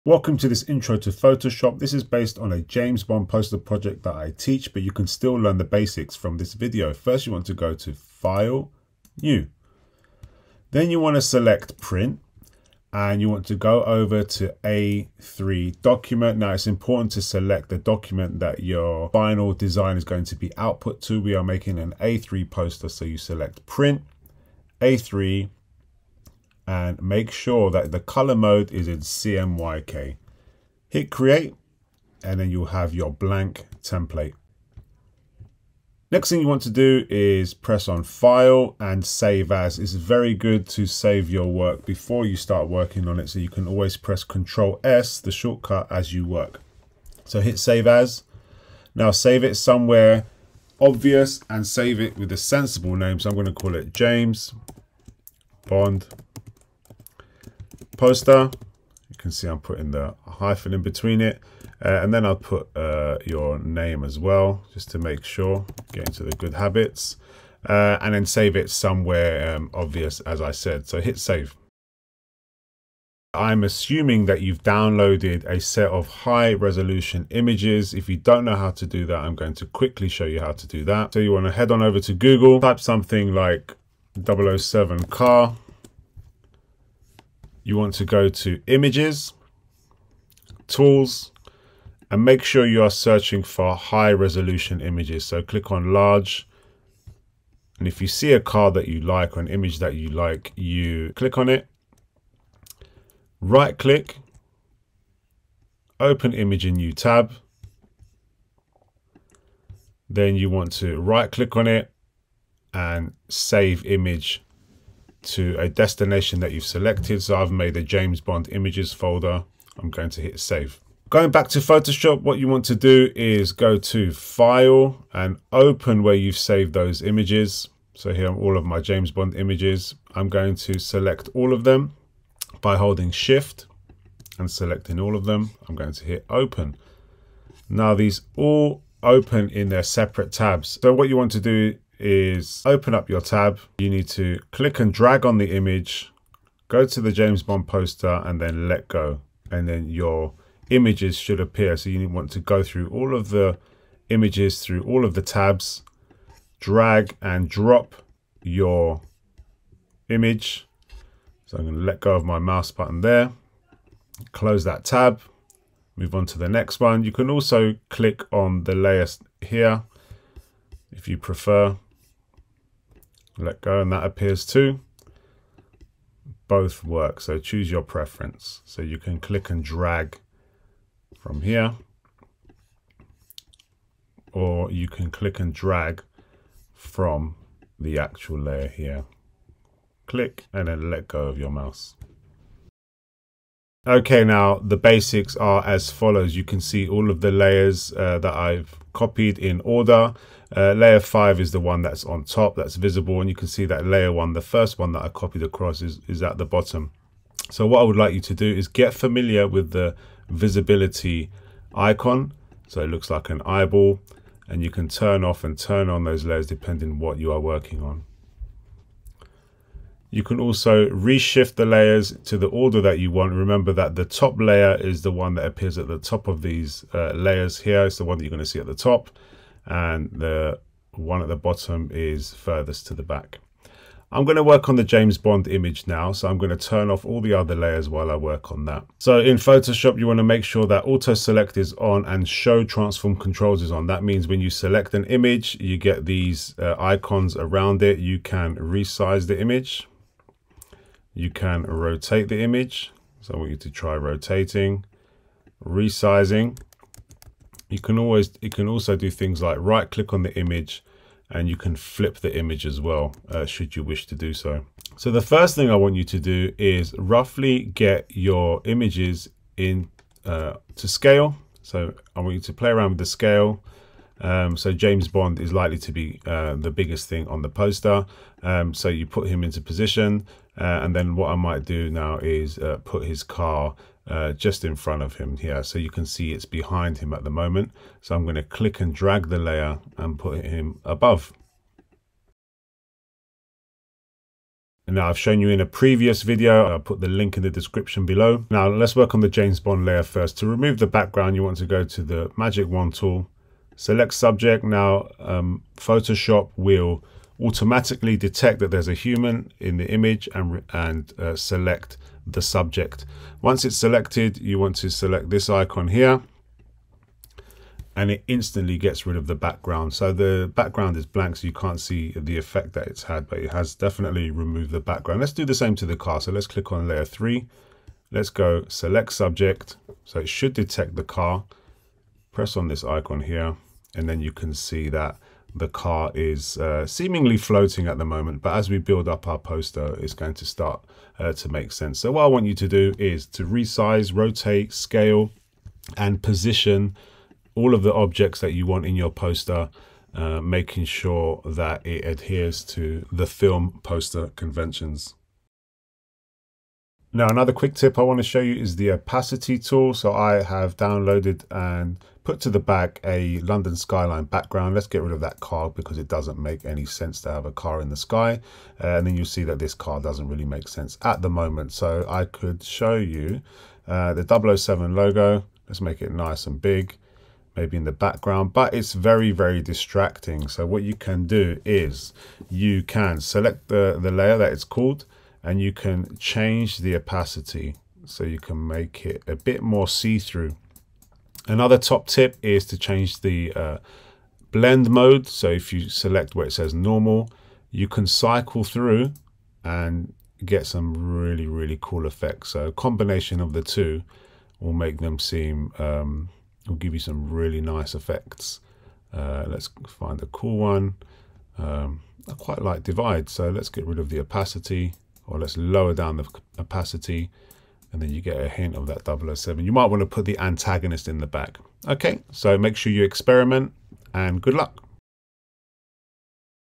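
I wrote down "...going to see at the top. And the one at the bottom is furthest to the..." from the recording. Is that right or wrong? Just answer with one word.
right.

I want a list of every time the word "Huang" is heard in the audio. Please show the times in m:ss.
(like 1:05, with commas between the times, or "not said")
not said.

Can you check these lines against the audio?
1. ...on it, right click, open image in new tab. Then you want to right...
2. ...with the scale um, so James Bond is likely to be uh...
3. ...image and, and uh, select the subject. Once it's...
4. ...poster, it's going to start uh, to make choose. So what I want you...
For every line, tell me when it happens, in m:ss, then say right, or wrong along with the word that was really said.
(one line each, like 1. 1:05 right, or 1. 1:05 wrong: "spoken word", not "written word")
1. 1:41 right
2. 4:32 right
3. 5:09 right
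4. 5:39 wrong: "sense", not "choose".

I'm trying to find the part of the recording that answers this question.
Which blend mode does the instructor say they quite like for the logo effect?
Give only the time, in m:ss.
6:52.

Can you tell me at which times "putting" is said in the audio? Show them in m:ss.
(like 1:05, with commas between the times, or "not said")
0:59.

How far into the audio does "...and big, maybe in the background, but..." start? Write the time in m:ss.
6:16.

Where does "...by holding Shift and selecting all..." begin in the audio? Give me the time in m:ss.
2:12.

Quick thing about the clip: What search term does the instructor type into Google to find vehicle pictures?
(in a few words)
007 car.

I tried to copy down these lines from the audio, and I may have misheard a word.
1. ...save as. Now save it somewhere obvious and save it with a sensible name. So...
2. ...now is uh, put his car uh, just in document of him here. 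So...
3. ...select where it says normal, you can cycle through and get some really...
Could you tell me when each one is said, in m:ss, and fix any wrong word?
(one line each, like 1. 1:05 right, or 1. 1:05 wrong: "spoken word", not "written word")
1. 0:47 right
2. 4:41 wrong: "front", not "document"
3. 6:35 right.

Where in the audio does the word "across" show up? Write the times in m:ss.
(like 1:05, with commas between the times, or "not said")
3:25.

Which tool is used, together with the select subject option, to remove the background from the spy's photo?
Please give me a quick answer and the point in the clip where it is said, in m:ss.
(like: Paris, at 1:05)
magic wand tool, at 5:02.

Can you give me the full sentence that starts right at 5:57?
Now, another quick tip I want to show you is the opacity tool.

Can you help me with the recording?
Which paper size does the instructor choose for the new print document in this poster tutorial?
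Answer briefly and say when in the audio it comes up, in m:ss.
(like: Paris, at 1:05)
A3, at 0:14.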